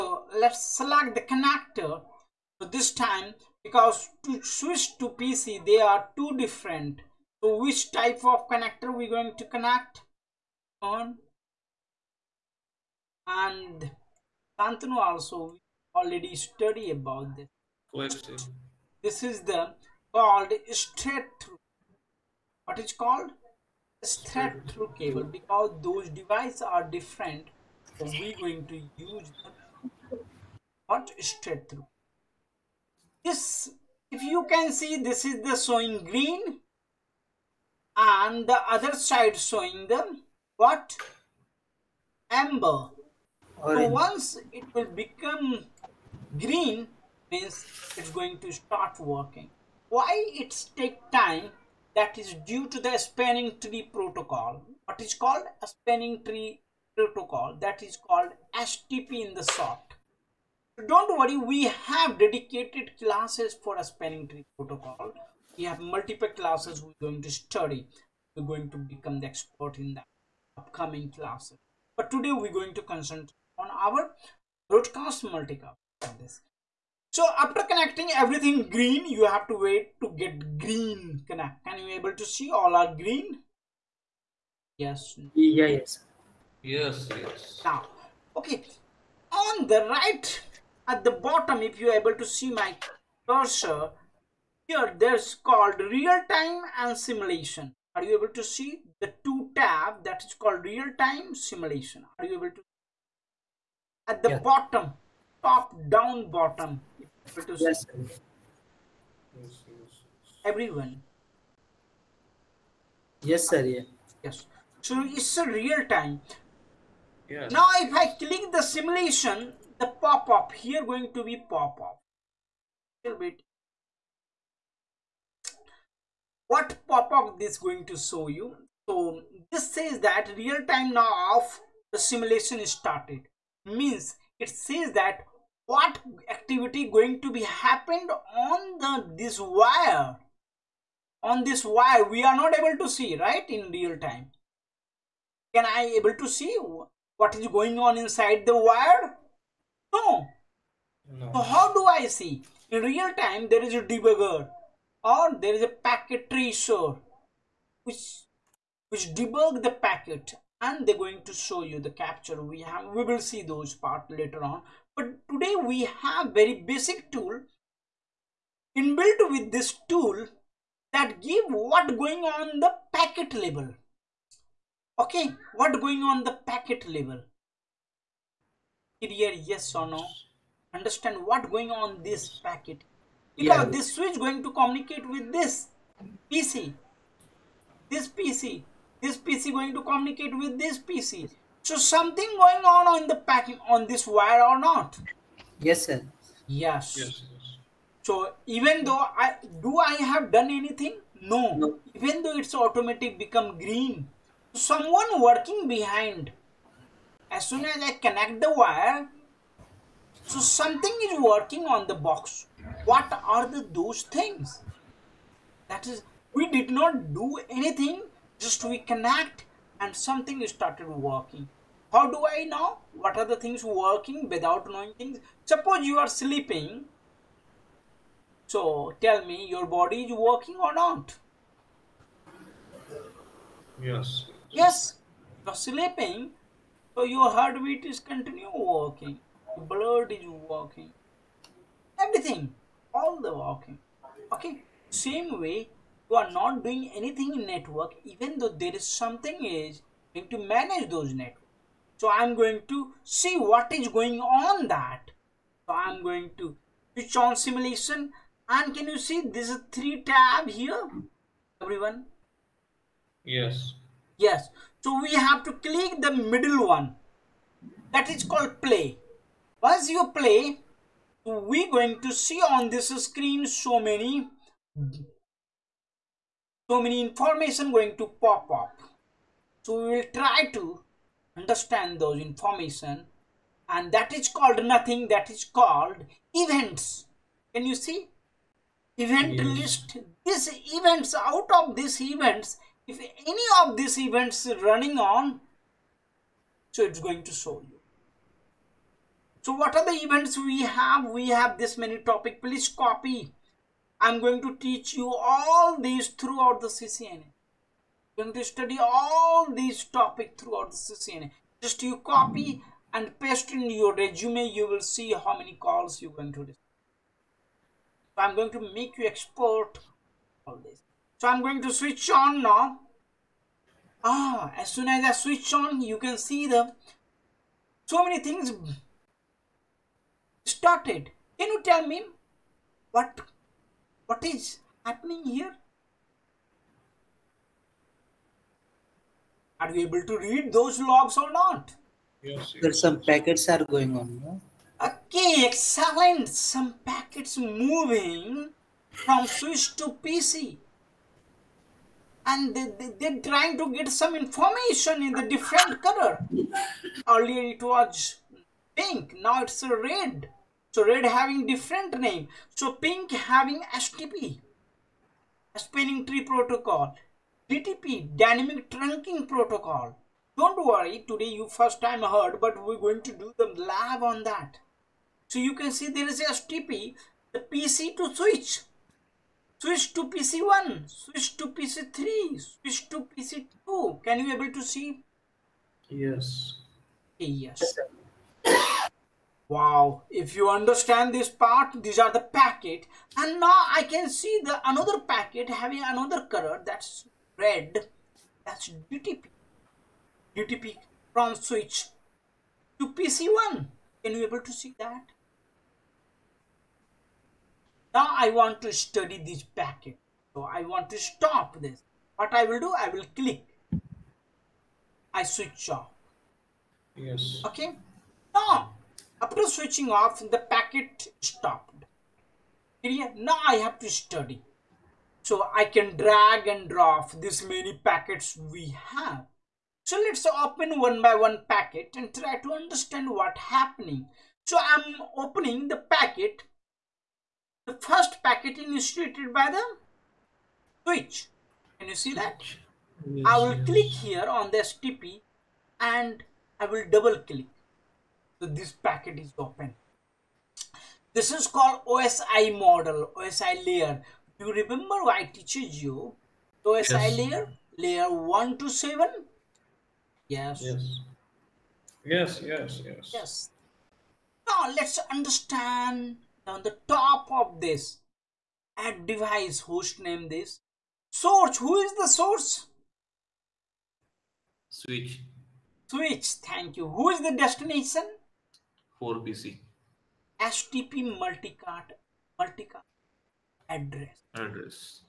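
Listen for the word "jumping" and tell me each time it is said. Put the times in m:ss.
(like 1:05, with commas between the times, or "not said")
not said.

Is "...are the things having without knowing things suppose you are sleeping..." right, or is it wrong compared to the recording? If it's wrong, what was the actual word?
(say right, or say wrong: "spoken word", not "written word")
wrong: "working", not "having".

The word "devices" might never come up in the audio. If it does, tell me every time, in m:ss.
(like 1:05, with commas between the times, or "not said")
0:26, 7:49.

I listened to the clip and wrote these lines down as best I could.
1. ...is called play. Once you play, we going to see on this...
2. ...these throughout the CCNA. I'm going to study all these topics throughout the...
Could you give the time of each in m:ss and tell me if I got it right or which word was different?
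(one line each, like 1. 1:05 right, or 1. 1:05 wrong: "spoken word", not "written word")
1. 4:28 right
2. 5:05 right.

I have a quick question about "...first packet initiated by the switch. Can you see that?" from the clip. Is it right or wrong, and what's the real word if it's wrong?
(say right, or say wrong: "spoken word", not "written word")
right.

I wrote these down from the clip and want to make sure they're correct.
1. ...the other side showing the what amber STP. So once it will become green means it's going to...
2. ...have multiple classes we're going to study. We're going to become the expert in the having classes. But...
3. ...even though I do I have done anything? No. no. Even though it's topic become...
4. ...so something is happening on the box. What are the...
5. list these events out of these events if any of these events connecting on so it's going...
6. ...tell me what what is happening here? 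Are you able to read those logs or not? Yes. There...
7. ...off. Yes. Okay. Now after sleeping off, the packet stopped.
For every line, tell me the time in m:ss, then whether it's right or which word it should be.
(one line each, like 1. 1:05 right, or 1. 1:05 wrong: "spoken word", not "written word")
1. 0:38 wrong: "Orange", not "STP"
2. 1:05 wrong: "upcoming", not "having"
3. 3:18 wrong: "automatic", not "topic"
4. 3:30 wrong: "working", not "happening"
5. 4:49 wrong: "running", not "connecting"
6. 5:31 right
7. 6:55 wrong: "switching", not "sleeping".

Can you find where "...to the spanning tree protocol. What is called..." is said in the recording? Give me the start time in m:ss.
0:52.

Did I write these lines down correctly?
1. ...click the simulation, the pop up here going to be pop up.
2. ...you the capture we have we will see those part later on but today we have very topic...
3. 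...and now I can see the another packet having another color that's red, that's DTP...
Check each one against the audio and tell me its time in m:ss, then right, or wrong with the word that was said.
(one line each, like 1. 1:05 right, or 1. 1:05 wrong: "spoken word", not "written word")
1. 1:58 right
2. 2:41 wrong: "basic", not "topic"
3. 6:33 right.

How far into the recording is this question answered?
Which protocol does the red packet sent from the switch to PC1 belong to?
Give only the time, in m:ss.
6:08.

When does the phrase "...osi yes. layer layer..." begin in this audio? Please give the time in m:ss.
7:36.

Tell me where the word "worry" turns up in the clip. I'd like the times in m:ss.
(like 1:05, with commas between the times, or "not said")
1:01, 6:10.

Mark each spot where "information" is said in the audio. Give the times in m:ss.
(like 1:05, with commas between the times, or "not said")
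4:37, 4:42, 5:54.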